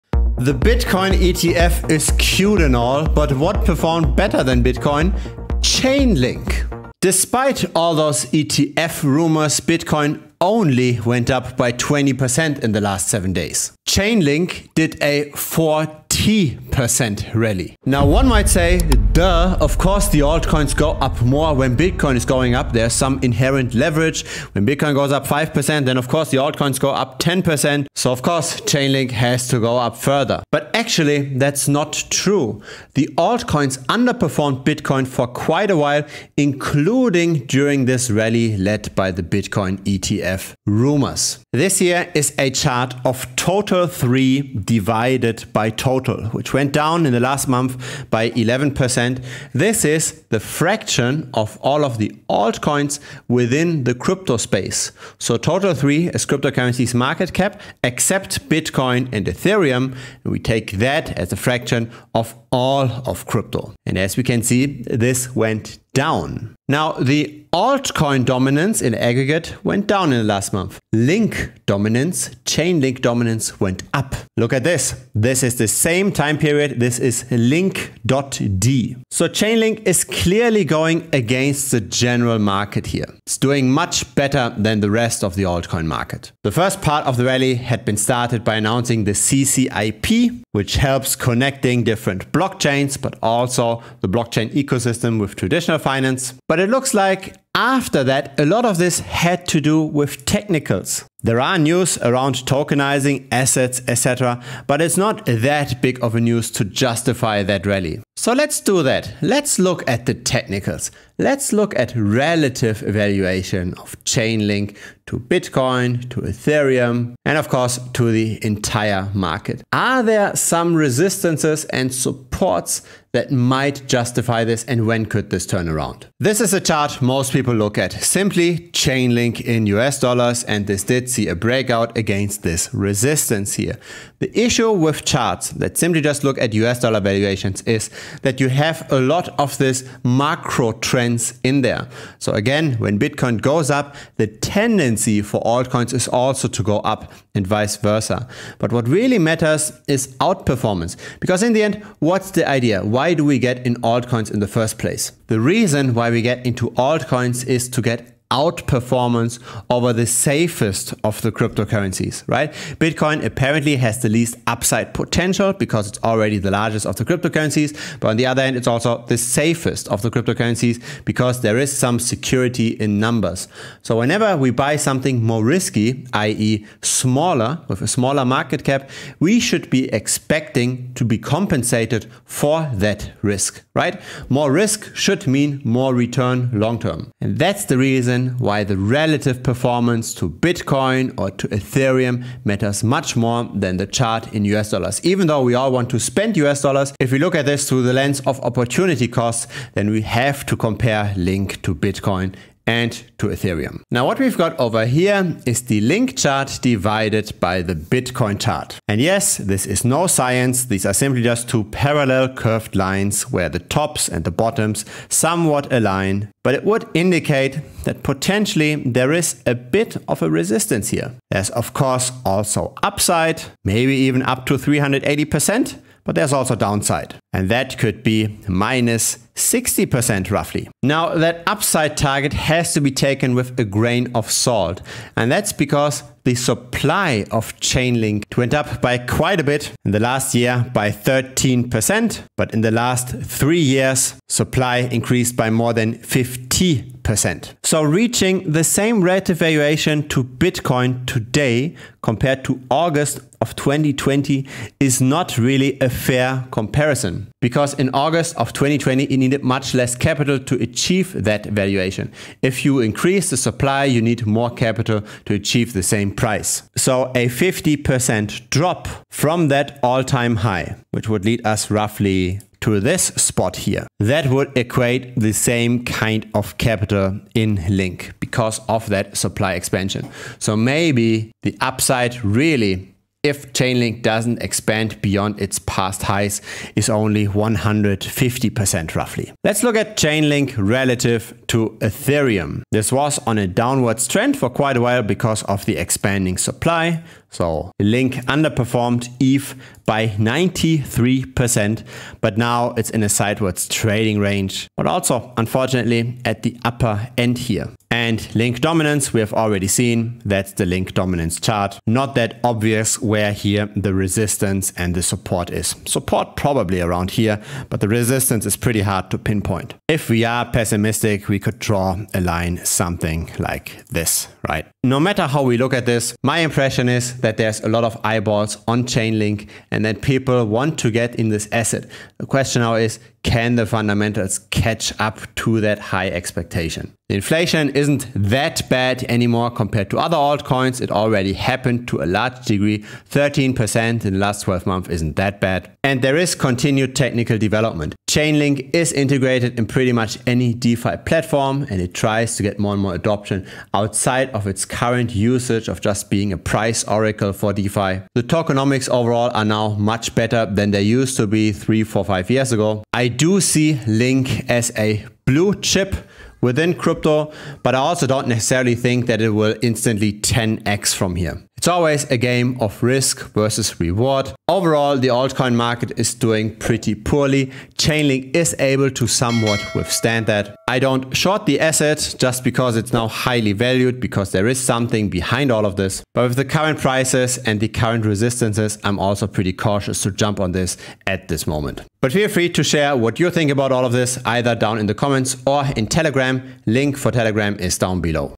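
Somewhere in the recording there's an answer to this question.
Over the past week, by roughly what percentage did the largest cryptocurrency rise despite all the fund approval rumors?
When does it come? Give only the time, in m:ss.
0:11.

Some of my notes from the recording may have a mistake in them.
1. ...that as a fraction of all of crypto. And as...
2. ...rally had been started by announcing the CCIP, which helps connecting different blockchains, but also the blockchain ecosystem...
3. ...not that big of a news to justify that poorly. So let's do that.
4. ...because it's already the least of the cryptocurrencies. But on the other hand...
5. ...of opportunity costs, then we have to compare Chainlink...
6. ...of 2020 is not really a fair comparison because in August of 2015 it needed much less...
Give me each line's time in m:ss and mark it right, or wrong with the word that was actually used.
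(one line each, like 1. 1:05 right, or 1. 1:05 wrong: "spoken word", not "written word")
1. 1:00 right
2. 1:27 right
3. 1:44 wrong: "rally", not "poorly"
4. 2:45 wrong: "largest", not "least"
5. 3:18 wrong: "Link", not "Chainlink"
6. 4:13 wrong: "2020", not "2015".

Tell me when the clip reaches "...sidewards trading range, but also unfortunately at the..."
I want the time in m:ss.
5:03.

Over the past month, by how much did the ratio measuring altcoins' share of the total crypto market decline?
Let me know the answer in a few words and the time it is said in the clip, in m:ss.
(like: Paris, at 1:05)
11%, at 0:48.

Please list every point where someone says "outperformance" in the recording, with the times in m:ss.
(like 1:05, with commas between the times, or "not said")
2:30, 2:38.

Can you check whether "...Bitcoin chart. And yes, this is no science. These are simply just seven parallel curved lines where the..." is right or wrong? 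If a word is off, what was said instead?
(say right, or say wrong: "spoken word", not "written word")
wrong: "two", not "seven".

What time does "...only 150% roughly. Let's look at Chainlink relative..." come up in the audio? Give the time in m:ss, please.
4:46.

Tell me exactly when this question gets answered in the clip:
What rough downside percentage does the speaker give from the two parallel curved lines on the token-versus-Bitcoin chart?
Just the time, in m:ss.
3:48.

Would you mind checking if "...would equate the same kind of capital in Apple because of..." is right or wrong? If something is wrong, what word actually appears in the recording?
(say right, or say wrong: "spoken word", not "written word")
wrong: "Link", not "Apple".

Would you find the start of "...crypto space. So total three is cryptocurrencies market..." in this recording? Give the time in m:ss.
0:53.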